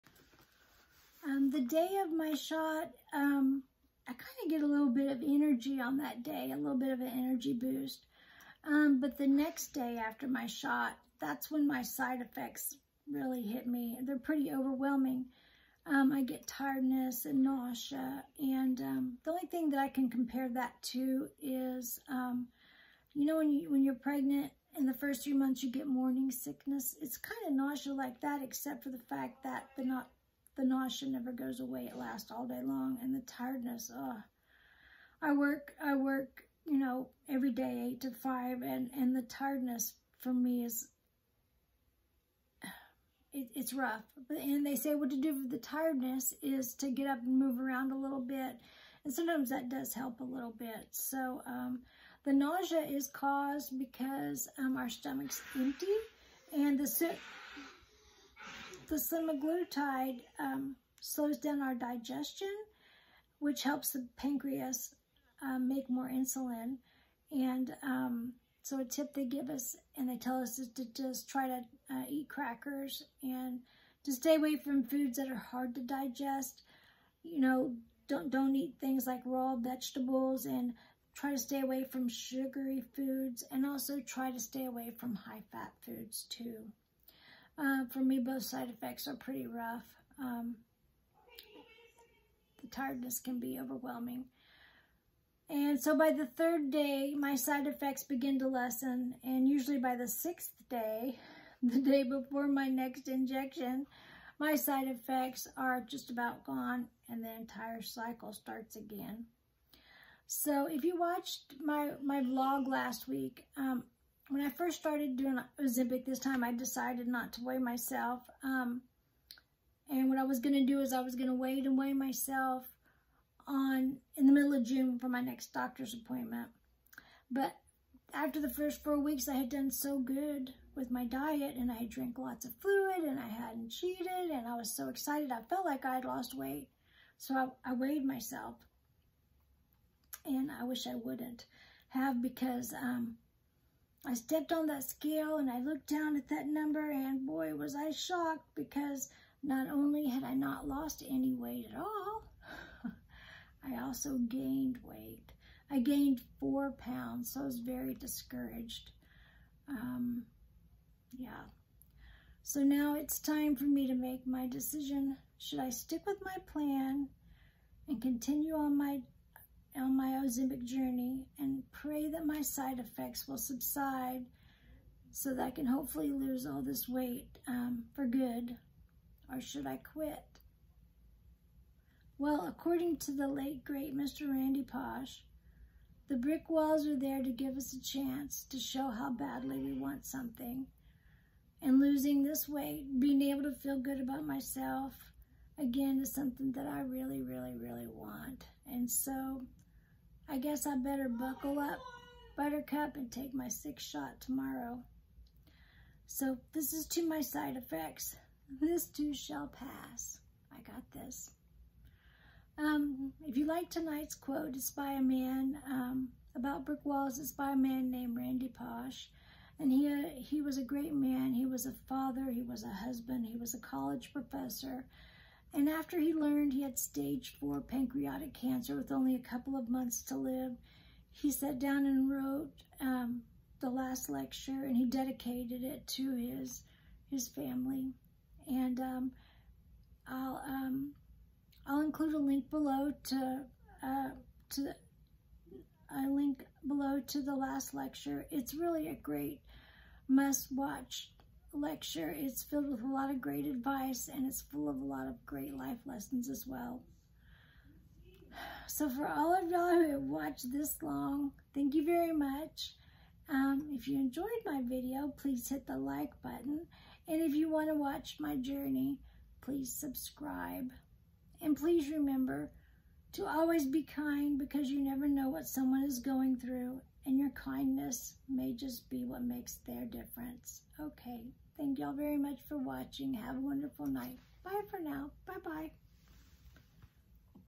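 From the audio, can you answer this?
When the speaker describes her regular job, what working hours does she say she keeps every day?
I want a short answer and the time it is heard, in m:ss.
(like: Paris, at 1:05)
8 to 5, at 0:37.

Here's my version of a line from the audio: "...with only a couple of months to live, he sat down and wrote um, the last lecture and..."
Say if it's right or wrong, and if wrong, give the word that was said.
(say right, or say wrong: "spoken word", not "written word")
right.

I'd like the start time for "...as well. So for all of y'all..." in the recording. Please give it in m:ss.
4:16.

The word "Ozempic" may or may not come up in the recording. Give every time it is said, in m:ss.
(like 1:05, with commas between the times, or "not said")
1:55, 2:50.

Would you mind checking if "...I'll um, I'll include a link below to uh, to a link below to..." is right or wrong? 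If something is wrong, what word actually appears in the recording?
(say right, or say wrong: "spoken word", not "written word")
right.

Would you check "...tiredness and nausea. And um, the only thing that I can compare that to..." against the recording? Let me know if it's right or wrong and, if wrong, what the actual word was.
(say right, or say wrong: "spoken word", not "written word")
right.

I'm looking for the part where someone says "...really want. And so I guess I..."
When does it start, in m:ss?
3:17.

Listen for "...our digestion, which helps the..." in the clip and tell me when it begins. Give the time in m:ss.
1:01.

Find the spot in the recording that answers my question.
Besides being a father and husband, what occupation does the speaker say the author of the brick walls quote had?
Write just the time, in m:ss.
3:43.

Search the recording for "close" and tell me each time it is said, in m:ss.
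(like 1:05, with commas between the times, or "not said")
not said.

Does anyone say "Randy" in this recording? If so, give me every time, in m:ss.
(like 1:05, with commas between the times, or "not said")
3:04, 3:38.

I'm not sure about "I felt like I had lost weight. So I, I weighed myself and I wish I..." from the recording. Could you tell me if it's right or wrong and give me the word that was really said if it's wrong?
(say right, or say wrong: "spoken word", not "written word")
right.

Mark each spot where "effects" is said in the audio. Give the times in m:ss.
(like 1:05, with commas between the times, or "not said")
0:12, 1:28, 1:37, 1:44, 2:52, 3:27.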